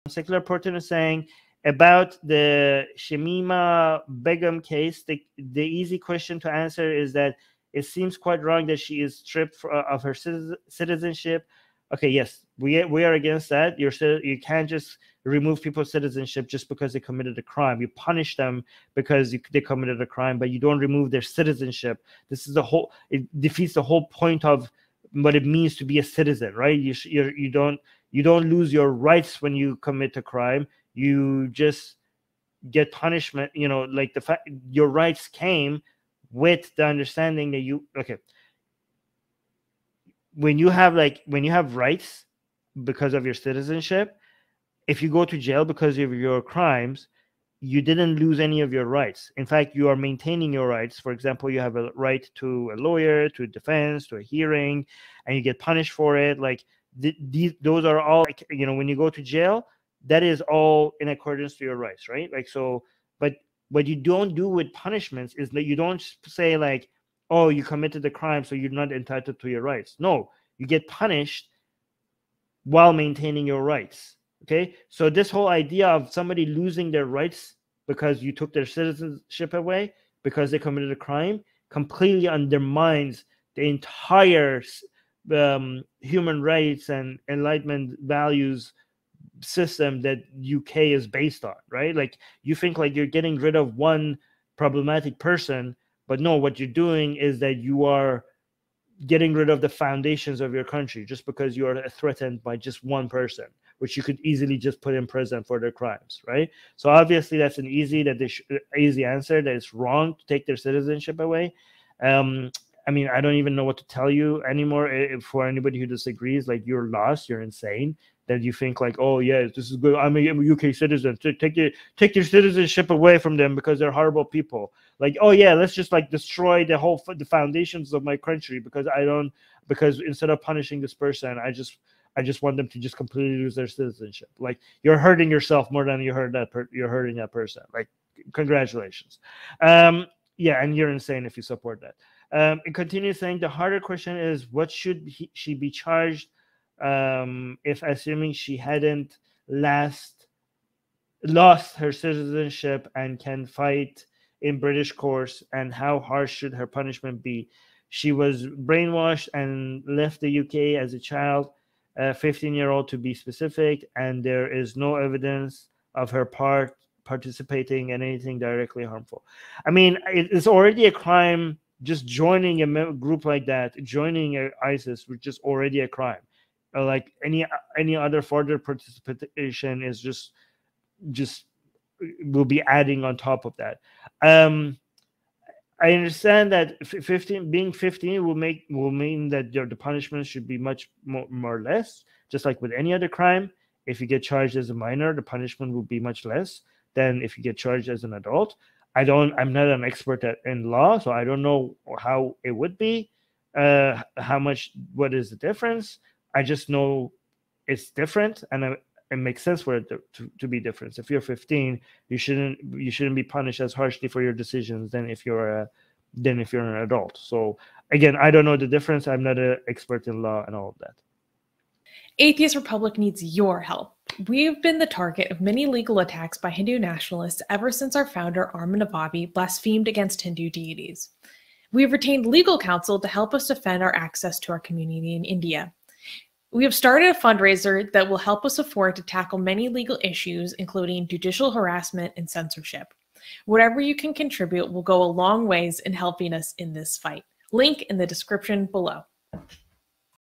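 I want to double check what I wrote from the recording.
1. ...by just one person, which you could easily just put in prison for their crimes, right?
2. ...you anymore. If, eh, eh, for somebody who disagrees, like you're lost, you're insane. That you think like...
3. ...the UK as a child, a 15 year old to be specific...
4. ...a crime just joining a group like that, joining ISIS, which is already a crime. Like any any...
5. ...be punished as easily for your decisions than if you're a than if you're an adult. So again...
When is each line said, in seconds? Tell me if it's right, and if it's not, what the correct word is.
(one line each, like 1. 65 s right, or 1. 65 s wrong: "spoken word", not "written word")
1. 102 s right
2. 114 s wrong: "anybody", not "somebody"
3. 160 s right
4. 170 s right
5. 213 s wrong: "harshly", not "easily".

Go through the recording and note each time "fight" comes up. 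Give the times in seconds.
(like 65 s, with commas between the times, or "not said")
153 s, 246 s.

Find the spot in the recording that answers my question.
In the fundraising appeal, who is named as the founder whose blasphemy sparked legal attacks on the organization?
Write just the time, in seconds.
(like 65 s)
228 s.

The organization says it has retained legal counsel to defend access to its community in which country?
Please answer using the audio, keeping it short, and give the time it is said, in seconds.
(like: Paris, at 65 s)
India, at 235 s.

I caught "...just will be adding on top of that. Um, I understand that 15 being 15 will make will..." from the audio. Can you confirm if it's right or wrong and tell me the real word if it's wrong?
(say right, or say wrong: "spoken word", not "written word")
right.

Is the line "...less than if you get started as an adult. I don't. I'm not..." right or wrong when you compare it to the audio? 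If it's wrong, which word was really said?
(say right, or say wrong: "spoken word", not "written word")
wrong: "charged", not "started".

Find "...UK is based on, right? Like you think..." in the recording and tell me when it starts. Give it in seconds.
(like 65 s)
90 s.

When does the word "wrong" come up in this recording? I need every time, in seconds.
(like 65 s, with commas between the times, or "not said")
8 s, 109 s.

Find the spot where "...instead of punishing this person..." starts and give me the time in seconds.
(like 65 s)
130 s.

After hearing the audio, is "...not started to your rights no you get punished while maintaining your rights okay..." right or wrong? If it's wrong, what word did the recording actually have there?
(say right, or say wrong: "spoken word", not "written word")
wrong: "entitled", not "started".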